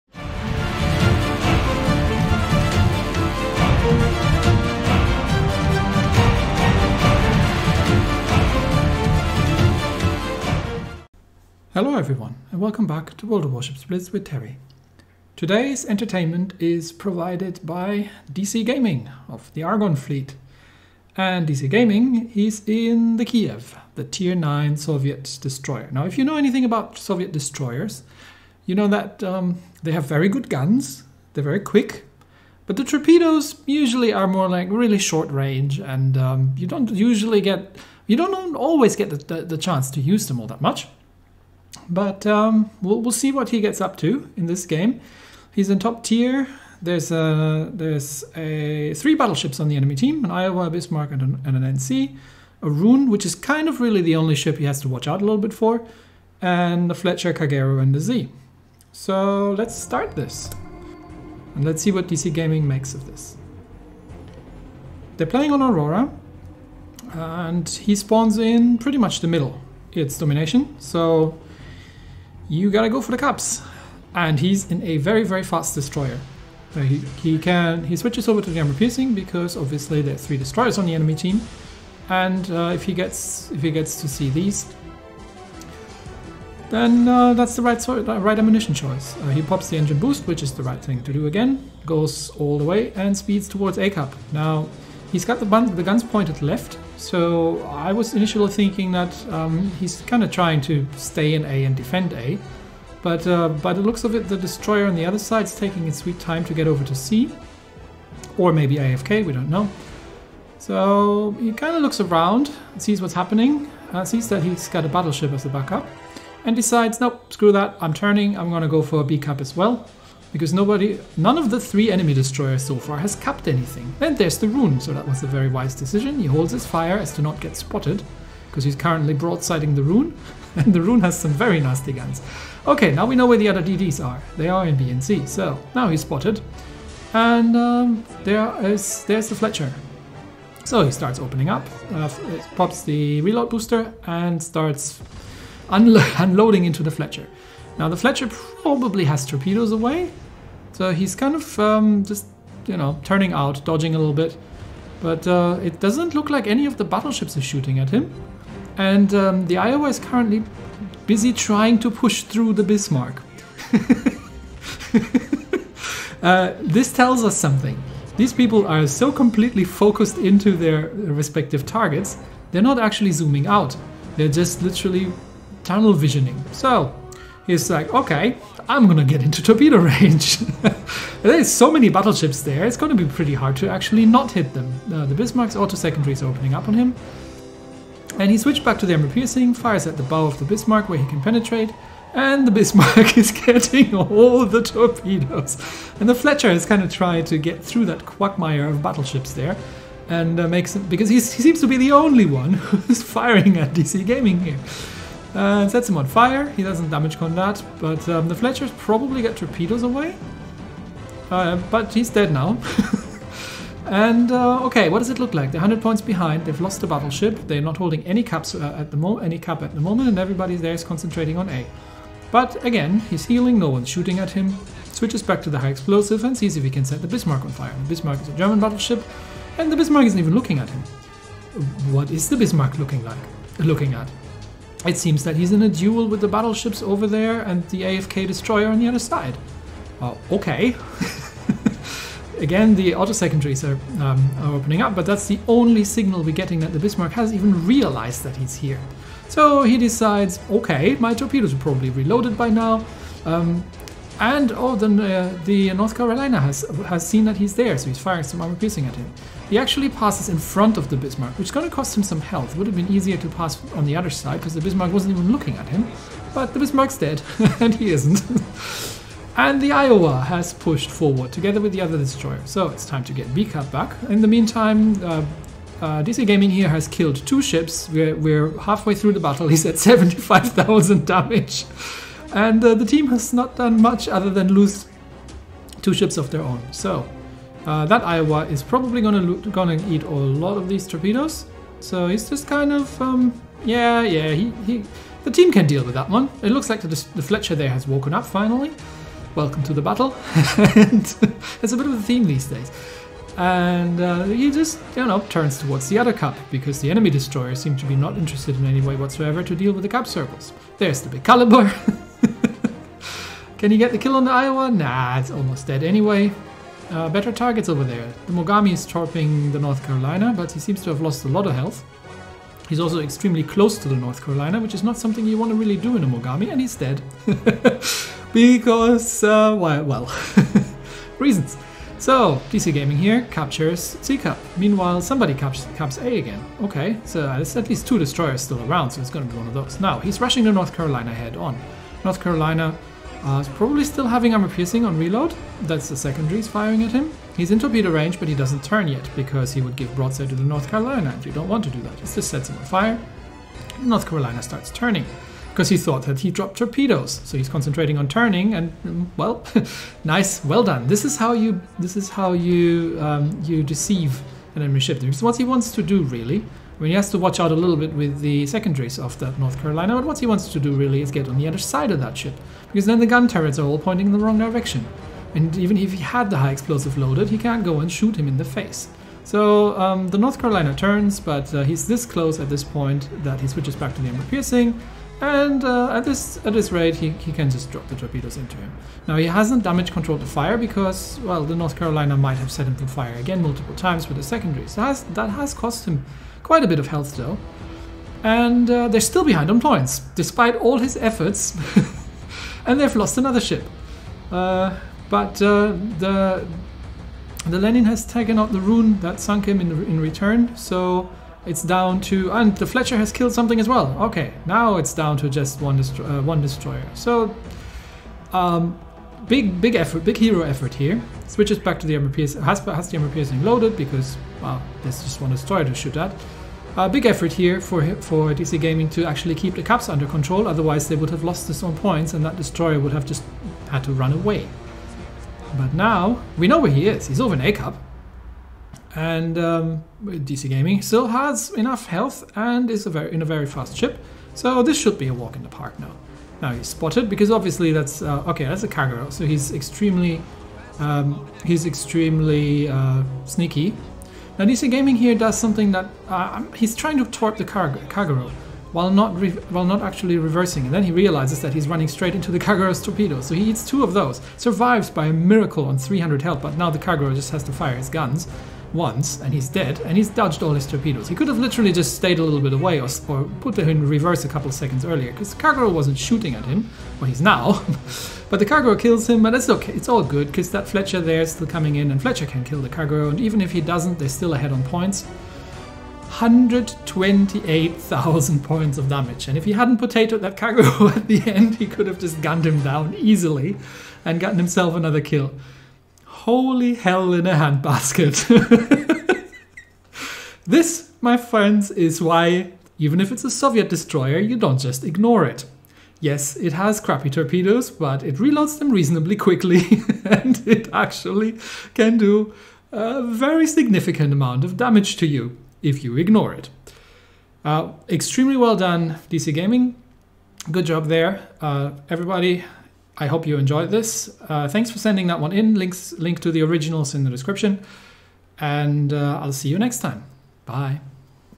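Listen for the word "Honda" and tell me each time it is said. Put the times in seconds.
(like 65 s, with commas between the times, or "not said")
not said.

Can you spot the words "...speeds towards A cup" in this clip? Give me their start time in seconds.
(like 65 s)
93 s.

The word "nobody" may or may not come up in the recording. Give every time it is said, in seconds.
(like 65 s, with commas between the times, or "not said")
120 s.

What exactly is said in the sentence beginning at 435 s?
But now, we know where he is, he's over in A-Cup.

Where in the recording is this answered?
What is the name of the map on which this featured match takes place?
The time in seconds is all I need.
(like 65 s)
65 s.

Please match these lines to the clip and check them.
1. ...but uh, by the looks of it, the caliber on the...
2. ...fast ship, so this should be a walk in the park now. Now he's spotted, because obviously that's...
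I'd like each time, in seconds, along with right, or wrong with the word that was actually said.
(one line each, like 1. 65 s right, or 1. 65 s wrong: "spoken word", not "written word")
1. 103 s wrong: "destroyer", not "caliber"
2. 443 s right.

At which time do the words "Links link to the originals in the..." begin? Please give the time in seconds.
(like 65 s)
525 s.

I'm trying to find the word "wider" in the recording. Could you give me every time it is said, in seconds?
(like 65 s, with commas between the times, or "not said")
not said.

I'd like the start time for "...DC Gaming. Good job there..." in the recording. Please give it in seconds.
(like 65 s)
519 s.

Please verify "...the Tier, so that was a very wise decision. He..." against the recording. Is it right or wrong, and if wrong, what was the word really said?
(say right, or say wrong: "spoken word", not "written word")
wrong: "Roon", not "Tier".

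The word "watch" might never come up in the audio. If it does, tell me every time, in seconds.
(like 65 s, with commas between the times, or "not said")
54 s, 367 s.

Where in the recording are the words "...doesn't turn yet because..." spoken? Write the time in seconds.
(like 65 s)
348 s.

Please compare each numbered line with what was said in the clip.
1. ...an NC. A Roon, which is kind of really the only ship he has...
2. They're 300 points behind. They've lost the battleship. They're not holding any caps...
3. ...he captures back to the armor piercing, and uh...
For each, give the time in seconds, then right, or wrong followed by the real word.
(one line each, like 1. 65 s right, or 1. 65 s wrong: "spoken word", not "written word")
1. 51 s right
2. 215 s wrong: "100", not "300"
3. 383 s wrong: "switches", not "captures".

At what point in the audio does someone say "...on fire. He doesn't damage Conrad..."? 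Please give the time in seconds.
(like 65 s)
205 s.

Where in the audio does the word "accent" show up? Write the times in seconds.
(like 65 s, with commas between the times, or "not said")
not said.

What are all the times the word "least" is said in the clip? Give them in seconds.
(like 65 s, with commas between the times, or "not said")
337 s.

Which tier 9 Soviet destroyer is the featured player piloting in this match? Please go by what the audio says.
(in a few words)
Kiev.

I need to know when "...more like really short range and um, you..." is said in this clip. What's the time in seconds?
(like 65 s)
34 s.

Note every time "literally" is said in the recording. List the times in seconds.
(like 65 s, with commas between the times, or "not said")
174 s, 471 s.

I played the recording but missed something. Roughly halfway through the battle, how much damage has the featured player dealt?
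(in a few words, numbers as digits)
75,000.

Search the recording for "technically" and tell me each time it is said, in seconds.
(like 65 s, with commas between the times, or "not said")
not said.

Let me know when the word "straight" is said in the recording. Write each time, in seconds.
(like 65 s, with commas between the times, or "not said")
461 s.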